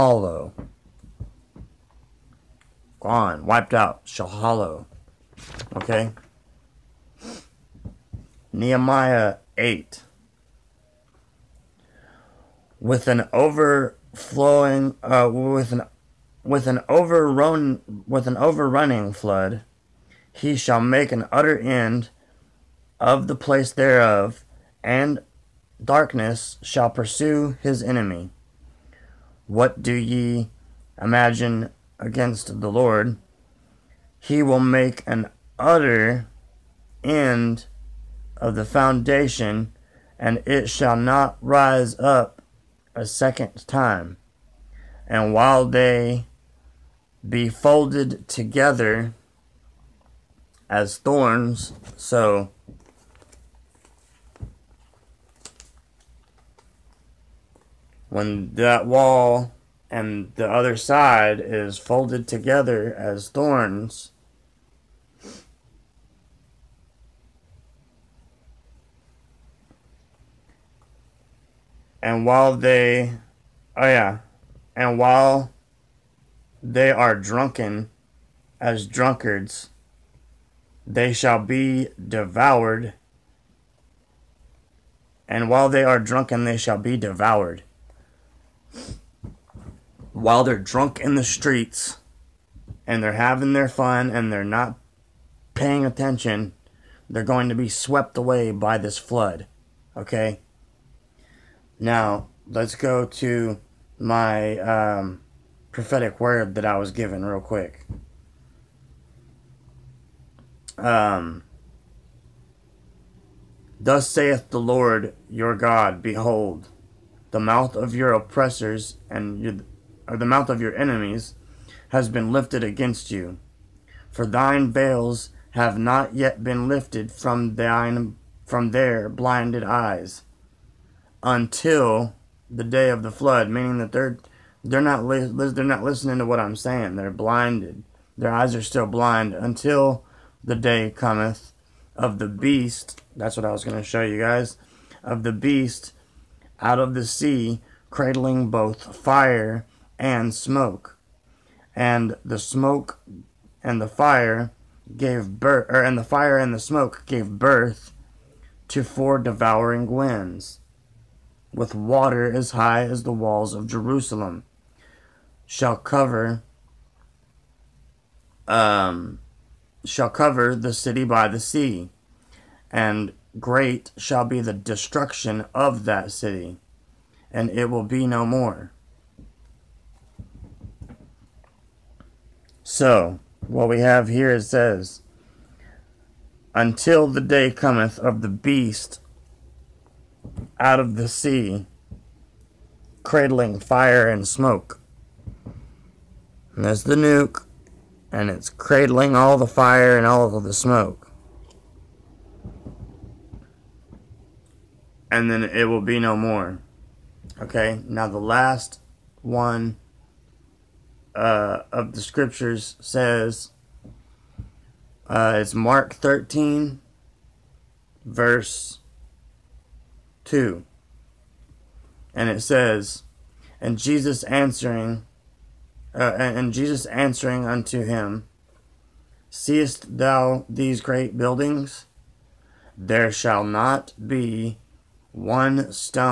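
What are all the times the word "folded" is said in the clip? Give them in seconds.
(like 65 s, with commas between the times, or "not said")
47 s, 61 s.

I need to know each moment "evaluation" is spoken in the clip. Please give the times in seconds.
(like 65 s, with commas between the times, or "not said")
not said.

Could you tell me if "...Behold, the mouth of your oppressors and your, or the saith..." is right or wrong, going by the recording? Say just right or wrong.
wrong.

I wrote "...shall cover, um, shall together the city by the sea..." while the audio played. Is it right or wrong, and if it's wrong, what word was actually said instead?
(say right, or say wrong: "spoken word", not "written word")
wrong: "cover", not "together".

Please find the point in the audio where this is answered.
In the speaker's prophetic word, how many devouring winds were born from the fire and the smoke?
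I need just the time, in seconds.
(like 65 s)
158 s.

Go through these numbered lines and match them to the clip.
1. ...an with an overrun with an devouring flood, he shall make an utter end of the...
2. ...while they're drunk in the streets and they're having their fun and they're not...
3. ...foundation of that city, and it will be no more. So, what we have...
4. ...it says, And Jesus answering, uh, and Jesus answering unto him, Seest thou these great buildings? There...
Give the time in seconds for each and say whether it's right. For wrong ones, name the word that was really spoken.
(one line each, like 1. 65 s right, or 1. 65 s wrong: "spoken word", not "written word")
1. 15 s wrong: "overrunning", not "devouring"
2. 90 s right
3. 174 s wrong: "destruction", not "foundation"
4. 222 s right.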